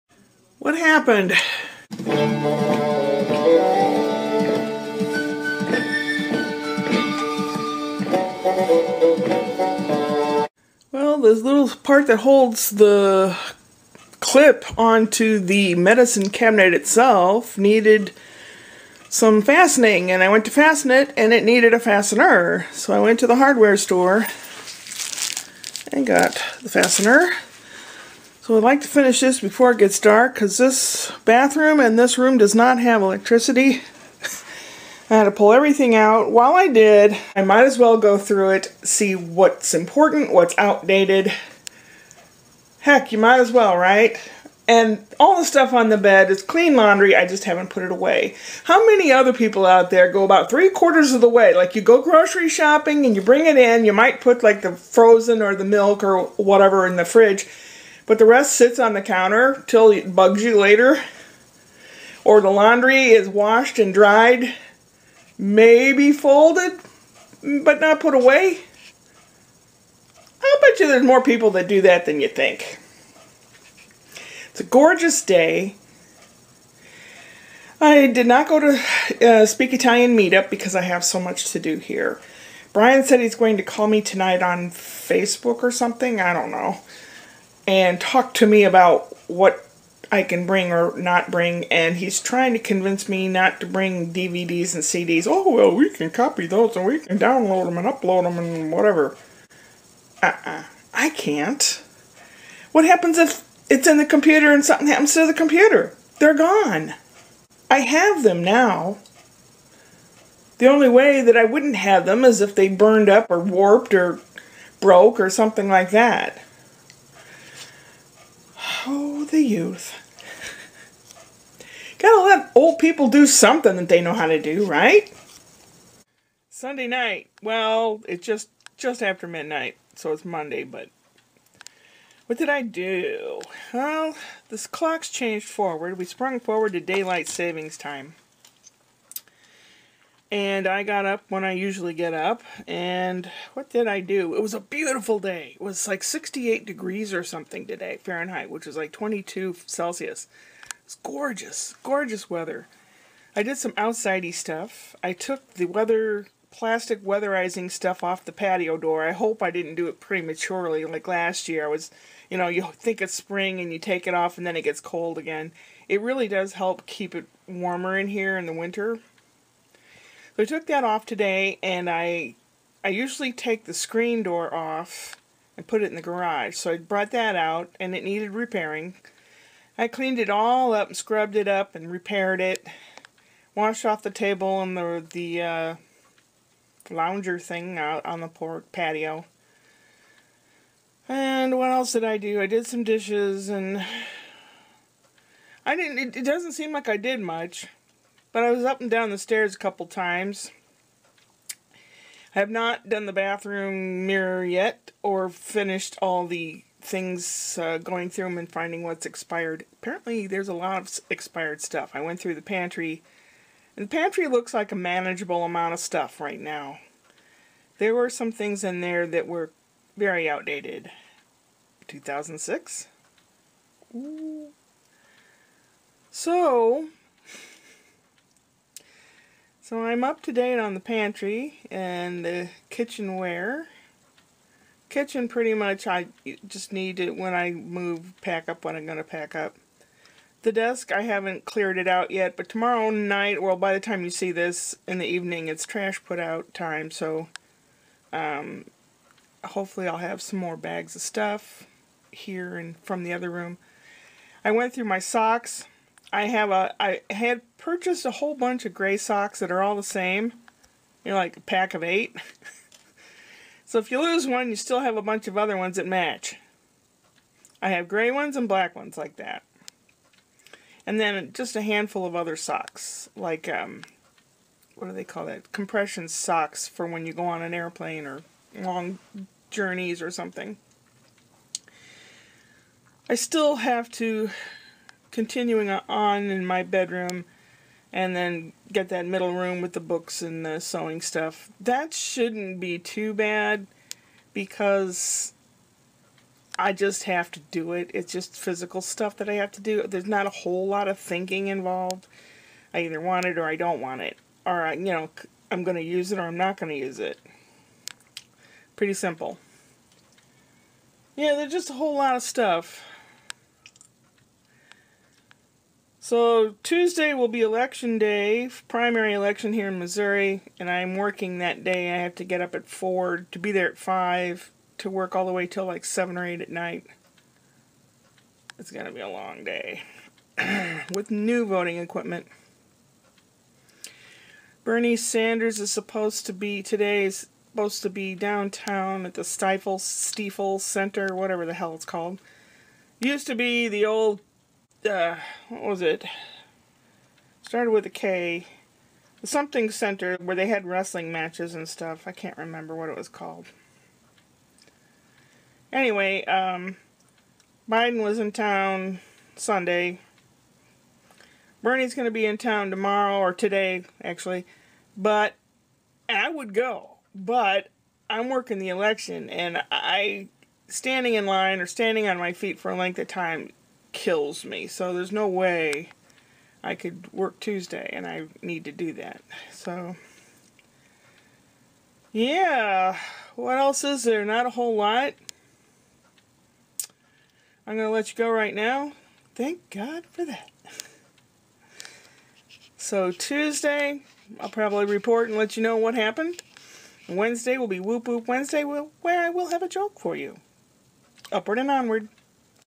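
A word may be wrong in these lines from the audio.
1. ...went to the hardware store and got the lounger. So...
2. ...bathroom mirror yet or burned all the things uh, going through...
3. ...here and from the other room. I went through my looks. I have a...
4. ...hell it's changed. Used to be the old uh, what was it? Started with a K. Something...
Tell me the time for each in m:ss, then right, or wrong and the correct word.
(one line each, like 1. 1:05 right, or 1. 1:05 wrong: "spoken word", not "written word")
1. 0:22 wrong: "fastener", not "lounger"
2. 3:23 wrong: "finished", not "burned"
3. 4:12 wrong: "socks", not "looks"
4. 5:41 wrong: "called", not "changed".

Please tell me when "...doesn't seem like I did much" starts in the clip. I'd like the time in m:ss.
3:16.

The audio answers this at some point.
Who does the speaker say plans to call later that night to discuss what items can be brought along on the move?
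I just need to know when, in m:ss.
1:22.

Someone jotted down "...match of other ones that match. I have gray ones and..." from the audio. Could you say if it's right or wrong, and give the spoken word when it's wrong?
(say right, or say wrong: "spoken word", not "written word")
wrong: "bunch", not "match".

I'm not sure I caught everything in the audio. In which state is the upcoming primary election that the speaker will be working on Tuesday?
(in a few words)
Missouri.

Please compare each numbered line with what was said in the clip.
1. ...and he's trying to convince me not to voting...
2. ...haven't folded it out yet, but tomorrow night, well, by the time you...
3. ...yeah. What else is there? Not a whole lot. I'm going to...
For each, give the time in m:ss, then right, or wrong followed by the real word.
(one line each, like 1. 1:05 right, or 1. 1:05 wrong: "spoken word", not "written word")
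1. 1:31 wrong: "bring", not "voting"
2. 4:01 wrong: "cleared", not "folded"
3. 6:22 right.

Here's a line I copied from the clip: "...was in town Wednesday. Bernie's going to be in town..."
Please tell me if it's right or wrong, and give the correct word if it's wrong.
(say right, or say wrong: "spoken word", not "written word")
wrong: "Sunday", not "Wednesday".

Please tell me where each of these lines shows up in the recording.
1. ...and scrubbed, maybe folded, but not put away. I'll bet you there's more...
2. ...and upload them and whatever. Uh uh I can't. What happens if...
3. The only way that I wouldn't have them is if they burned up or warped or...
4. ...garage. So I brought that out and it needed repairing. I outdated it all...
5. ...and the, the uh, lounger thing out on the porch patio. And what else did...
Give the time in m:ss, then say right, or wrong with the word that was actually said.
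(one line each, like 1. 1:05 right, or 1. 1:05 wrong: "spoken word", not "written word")
1. 1:03 wrong: "dried", not "scrubbed"
2. 1:37 right
3. 1:50 right
4. 2:56 wrong: "cleaned", not "outdated"
5. 3:04 right.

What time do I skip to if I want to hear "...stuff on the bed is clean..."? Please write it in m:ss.
0:45.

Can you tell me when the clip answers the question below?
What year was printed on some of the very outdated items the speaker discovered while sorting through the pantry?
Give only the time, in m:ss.
3:41.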